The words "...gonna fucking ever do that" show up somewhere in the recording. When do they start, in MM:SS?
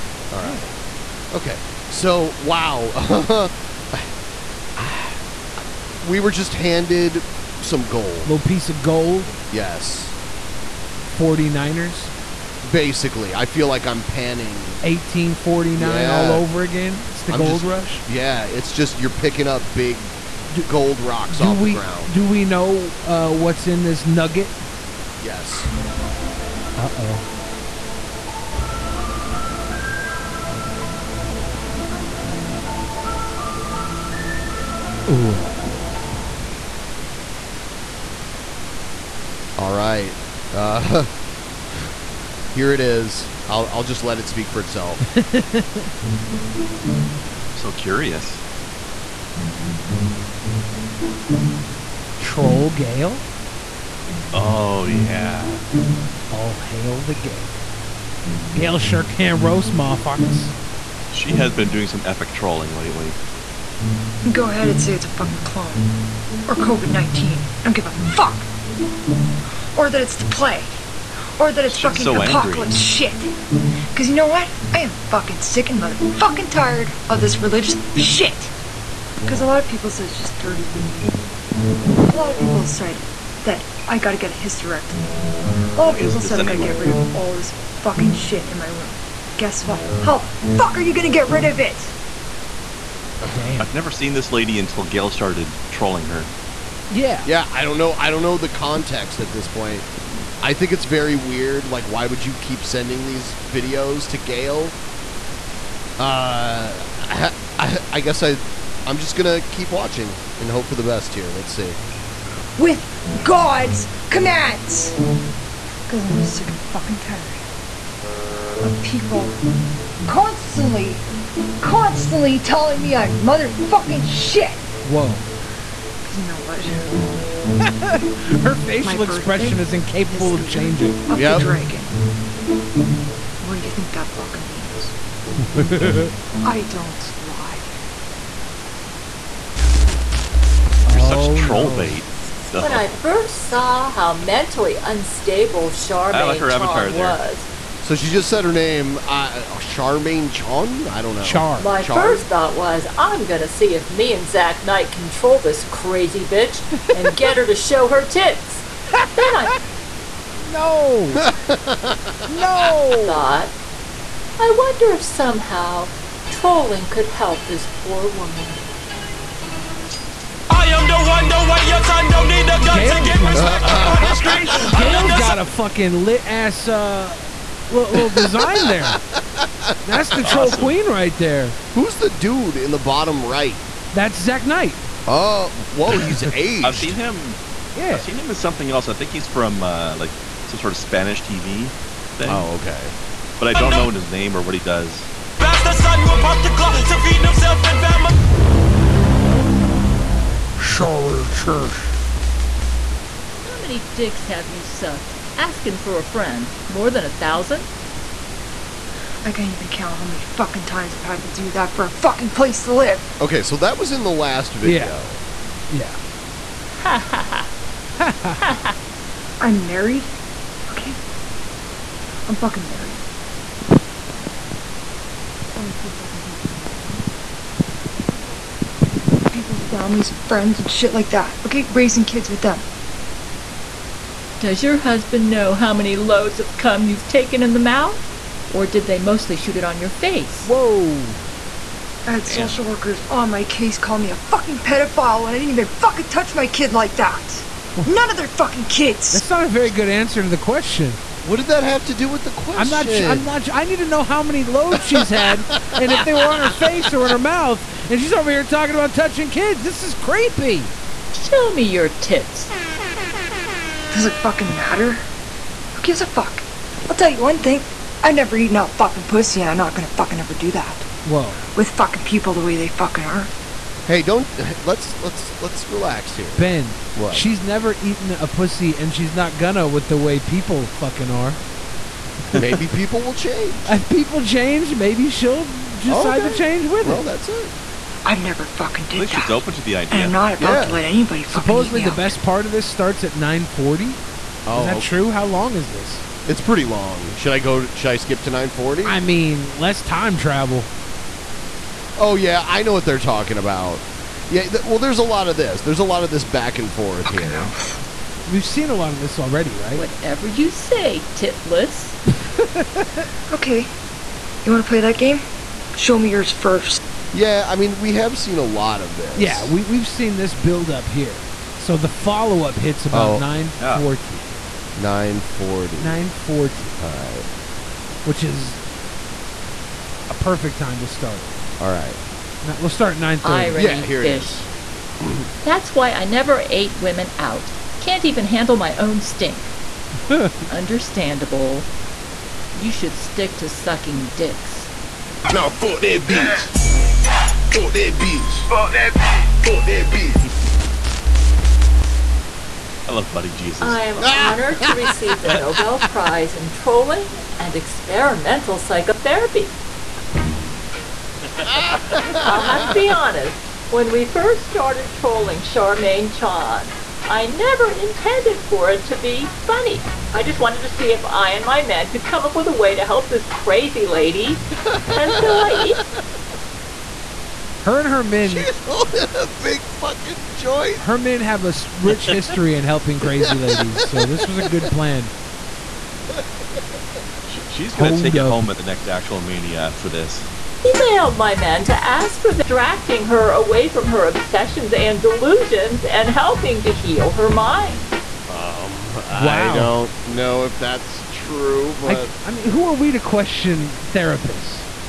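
04:29.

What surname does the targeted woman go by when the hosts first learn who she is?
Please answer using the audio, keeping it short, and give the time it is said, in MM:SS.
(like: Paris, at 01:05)
Chon, at 02:29.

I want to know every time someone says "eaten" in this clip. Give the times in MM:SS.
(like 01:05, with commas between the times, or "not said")
04:28, 04:37.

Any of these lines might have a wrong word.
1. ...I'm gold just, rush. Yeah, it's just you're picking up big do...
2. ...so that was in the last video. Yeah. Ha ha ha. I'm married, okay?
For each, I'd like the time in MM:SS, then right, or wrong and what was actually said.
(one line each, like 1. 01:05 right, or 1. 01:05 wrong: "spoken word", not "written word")
1. 00:17 right
2. 03:33 right.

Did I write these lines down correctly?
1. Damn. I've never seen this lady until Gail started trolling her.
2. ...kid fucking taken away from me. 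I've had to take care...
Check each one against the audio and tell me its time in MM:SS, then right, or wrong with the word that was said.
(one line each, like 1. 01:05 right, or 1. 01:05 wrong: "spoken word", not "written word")
1. 01:33 right
2. 03:45 right.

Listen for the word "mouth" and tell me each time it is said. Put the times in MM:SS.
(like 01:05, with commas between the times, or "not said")
03:57, 04:17.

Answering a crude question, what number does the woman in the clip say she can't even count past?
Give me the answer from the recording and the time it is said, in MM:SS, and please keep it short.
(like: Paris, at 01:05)
More than 1000, at 03:26.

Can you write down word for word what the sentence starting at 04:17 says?
And she's over here talking about touching kids.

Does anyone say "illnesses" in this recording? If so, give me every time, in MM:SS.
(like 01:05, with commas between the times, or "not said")
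not said.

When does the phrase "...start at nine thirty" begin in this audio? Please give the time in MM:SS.
05:32.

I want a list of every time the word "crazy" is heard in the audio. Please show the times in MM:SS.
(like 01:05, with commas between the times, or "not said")
02:35, 06:13, 06:22.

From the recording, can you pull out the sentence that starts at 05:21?
So the follow up hits about oh.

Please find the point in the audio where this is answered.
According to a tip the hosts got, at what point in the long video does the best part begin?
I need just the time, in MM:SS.
04:53.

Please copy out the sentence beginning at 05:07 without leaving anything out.
'Cause We've seen a lot of this already, right?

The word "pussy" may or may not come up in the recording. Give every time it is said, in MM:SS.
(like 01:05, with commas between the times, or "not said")
04:29, 04:38.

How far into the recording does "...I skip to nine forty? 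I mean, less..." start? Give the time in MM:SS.
04:57.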